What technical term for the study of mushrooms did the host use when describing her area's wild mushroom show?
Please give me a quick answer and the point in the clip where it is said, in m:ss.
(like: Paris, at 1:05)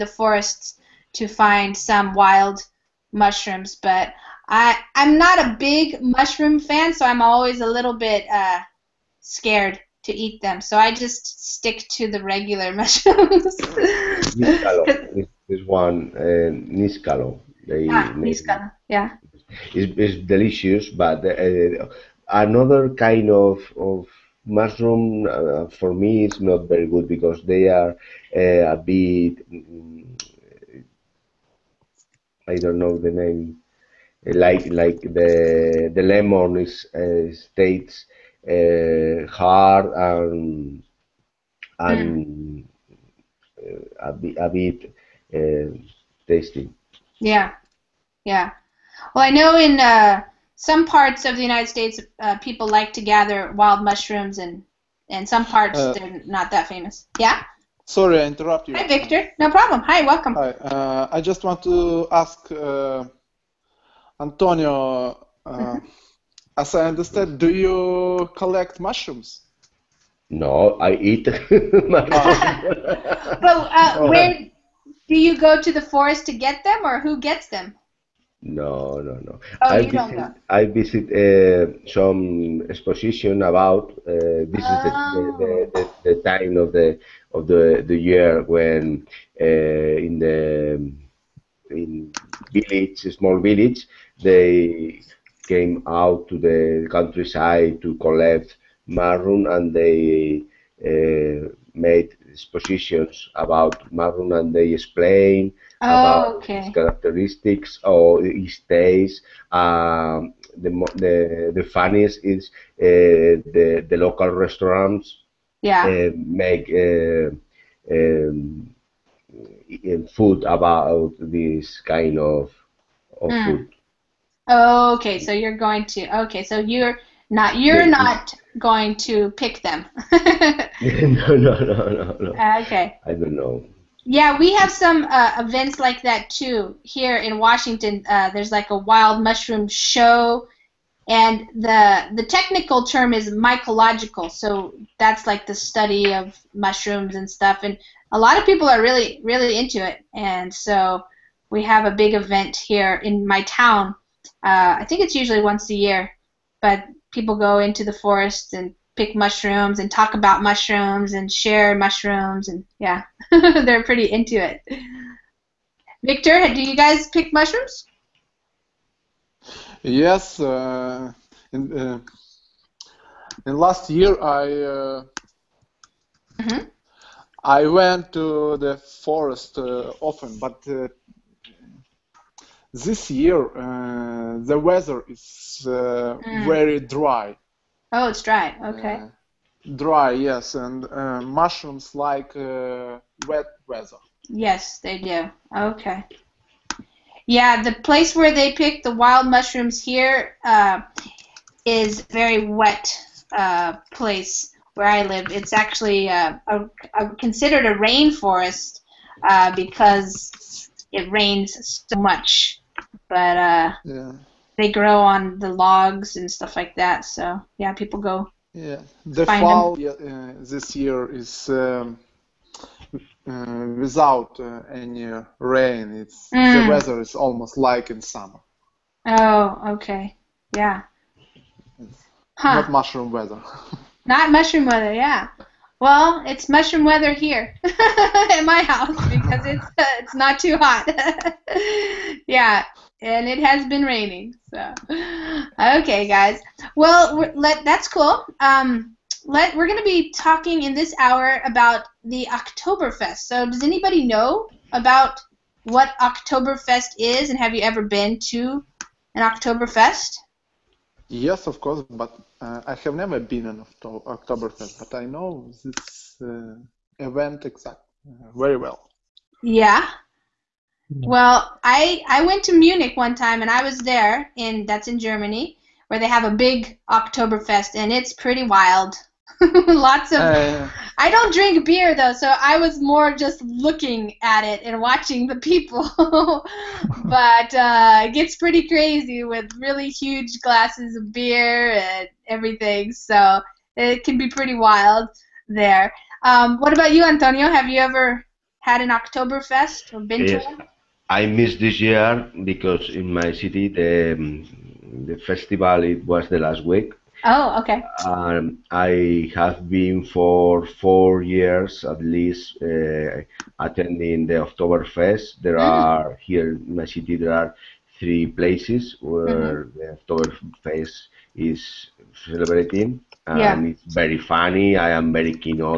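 mycological, at 2:23.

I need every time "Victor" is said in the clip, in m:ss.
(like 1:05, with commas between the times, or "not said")
0:58, 2:46.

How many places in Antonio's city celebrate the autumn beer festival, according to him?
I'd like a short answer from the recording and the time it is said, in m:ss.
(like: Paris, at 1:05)
3, at 5:17.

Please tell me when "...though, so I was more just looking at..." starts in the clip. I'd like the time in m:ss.
4:41.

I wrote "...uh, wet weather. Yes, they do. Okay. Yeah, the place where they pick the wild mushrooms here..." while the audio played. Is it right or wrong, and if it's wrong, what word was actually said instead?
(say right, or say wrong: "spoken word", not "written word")
right.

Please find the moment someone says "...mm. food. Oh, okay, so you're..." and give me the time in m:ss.
2:03.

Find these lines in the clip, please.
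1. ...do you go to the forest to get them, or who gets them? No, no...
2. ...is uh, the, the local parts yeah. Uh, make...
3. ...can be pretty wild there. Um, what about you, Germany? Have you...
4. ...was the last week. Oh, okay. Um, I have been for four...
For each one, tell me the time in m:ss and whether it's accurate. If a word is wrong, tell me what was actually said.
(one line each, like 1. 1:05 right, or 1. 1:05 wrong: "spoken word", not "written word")
1. 1:15 right
2. 1:52 wrong: "restaurants", not "parts"
3. 4:54 wrong: "Antonio", not "Germany"
4. 5:06 right.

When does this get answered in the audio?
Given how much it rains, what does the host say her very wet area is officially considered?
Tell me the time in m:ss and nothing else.
3:27.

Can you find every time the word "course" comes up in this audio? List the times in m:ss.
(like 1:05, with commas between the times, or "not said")
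4:21.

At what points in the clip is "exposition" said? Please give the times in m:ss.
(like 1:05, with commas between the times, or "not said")
1:22, 1:42.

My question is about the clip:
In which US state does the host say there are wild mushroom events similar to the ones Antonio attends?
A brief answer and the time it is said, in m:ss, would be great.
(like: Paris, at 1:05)
Washington, at 2:17.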